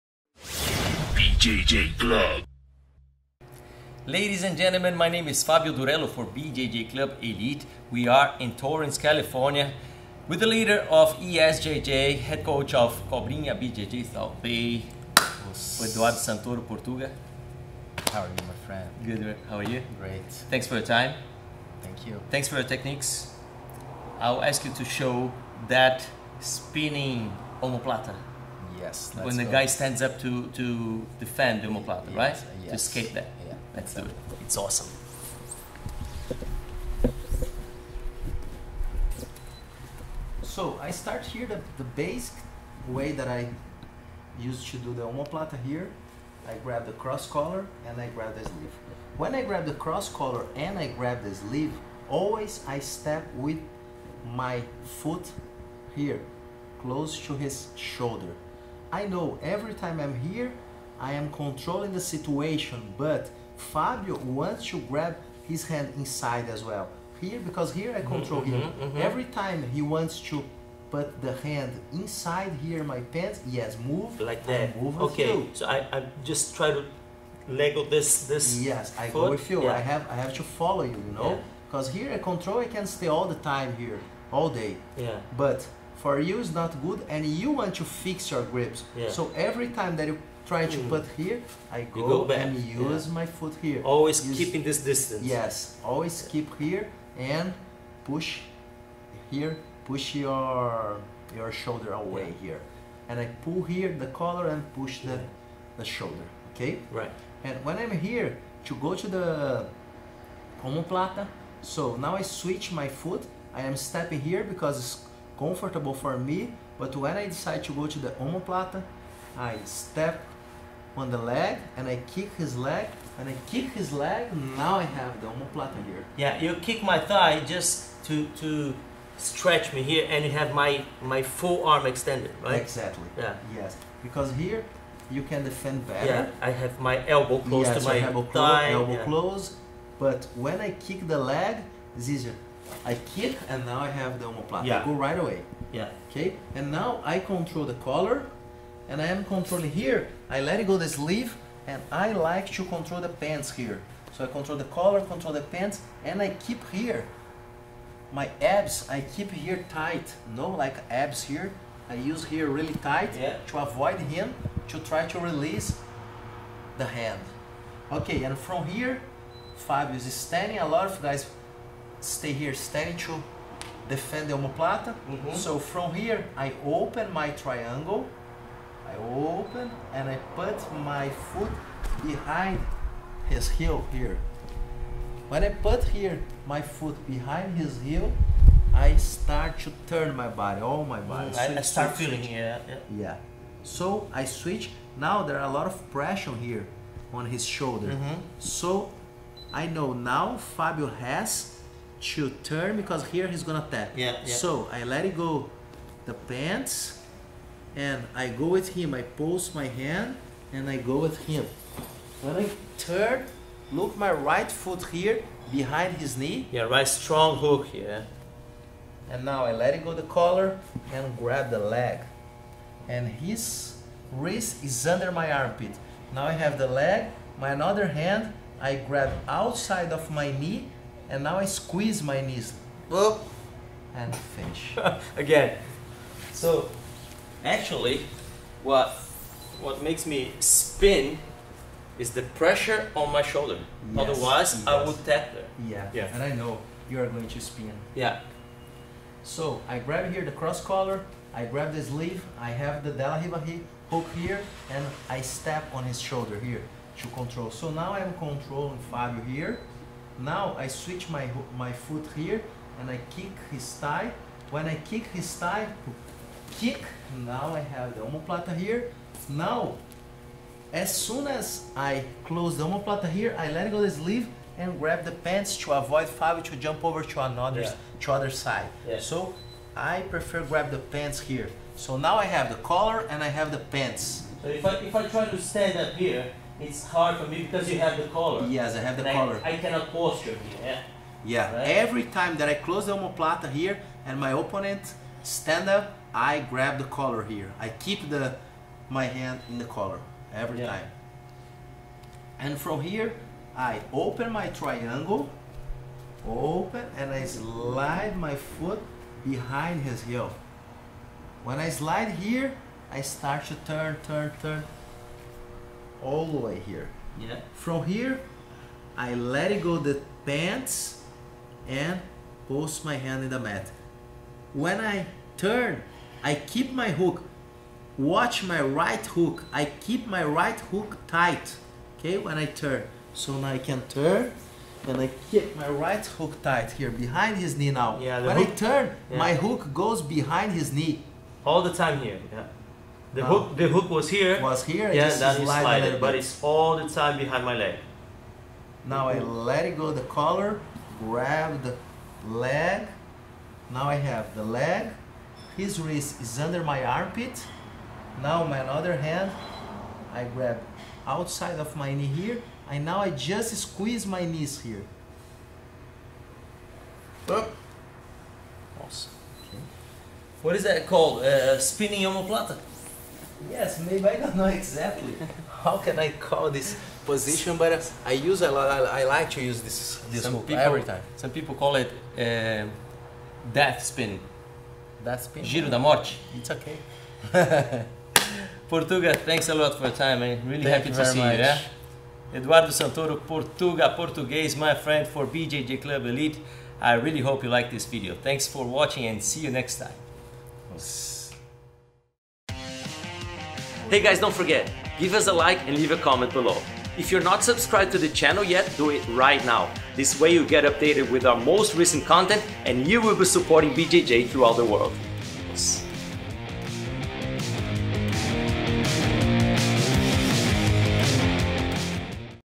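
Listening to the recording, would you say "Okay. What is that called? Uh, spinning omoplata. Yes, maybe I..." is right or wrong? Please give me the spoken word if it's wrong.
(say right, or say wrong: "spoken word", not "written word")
right.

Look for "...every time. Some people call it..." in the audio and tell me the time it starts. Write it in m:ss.
6:20.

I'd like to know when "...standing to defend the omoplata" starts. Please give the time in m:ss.
2:52.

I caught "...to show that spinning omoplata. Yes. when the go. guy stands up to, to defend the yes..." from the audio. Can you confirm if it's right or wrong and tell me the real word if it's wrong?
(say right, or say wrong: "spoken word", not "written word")
right.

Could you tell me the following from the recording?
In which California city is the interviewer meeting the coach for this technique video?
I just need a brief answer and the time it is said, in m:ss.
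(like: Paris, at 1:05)
Torrance, at 0:08.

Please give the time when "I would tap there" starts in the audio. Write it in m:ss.
4:04.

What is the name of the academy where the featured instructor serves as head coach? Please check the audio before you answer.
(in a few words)
Cobrinha BJJ South Bay.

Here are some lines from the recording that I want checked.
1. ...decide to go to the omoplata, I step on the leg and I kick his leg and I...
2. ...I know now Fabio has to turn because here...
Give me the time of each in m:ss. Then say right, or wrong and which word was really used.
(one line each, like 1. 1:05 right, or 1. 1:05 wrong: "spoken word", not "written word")
1. 1:57 right
2. 3:19 right.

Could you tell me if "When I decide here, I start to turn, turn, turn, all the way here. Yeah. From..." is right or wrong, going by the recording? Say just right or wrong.
wrong.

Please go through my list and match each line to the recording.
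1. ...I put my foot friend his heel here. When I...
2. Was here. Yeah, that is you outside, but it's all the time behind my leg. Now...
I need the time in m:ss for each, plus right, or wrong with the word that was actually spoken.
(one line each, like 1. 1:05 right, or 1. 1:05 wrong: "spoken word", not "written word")
1. 3:00 wrong: "behind", not "friend"
2. 5:44 wrong: "slide", not "outside".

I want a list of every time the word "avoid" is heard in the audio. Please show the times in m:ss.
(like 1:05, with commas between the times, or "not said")
2:43, 4:35.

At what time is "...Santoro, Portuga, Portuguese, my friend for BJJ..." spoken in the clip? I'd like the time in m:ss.
6:32.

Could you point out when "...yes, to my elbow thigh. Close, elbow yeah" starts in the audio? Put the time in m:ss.
2:17.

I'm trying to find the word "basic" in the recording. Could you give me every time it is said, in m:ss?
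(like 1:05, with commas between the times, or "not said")
0:41.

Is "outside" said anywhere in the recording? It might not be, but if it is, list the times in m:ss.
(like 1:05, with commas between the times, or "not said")
3:49, 6:01.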